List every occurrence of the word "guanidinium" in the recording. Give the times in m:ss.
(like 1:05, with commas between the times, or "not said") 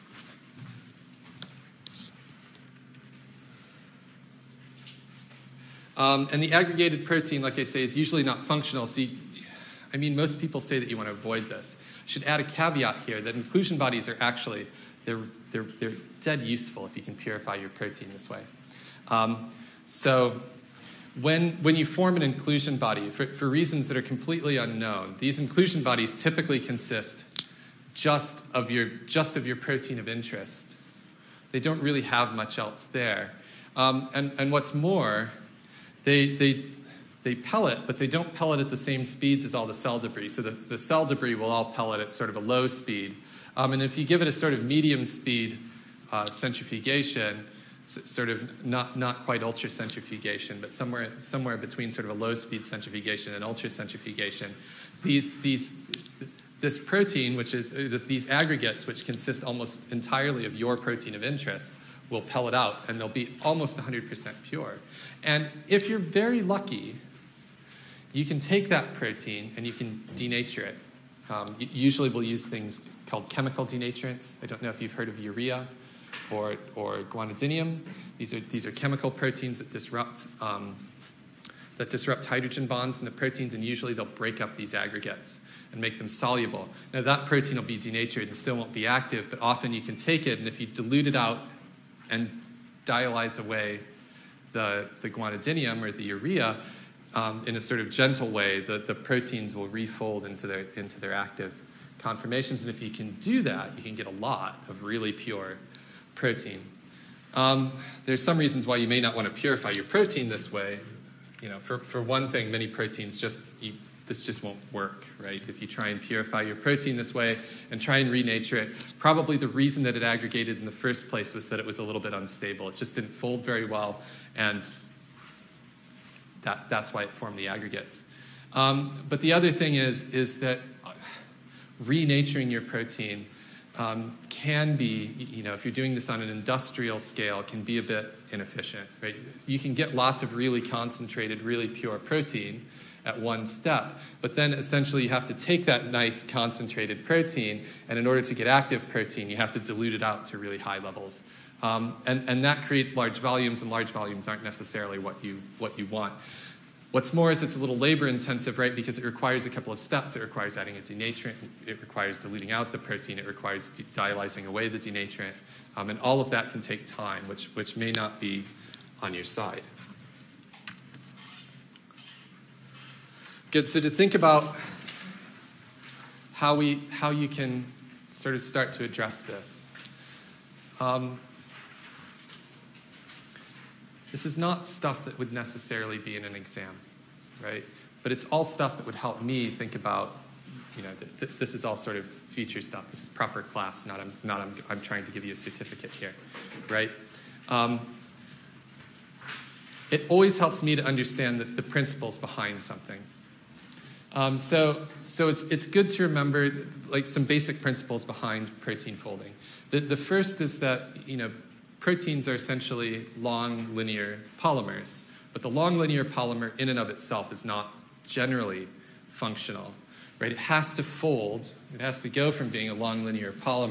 1:17, 1:35.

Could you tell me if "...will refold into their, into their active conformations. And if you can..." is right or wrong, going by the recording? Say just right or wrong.
right.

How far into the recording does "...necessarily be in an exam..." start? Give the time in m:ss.
3:05.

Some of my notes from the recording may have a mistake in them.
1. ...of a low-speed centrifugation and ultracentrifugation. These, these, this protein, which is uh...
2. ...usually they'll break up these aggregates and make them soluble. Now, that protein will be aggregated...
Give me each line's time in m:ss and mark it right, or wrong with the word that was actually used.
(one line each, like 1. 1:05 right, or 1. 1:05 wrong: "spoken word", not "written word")
1. 0:52 right
2. 1:23 wrong: "denatured", not "aggregated".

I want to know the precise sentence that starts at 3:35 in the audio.
But the long linear polymer in and of itself is not generally functional.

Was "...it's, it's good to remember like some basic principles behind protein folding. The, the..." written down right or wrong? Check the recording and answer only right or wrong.
right.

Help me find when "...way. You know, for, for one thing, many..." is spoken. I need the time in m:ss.
1:50.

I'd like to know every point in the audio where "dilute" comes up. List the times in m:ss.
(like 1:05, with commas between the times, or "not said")
1:30, 2:29.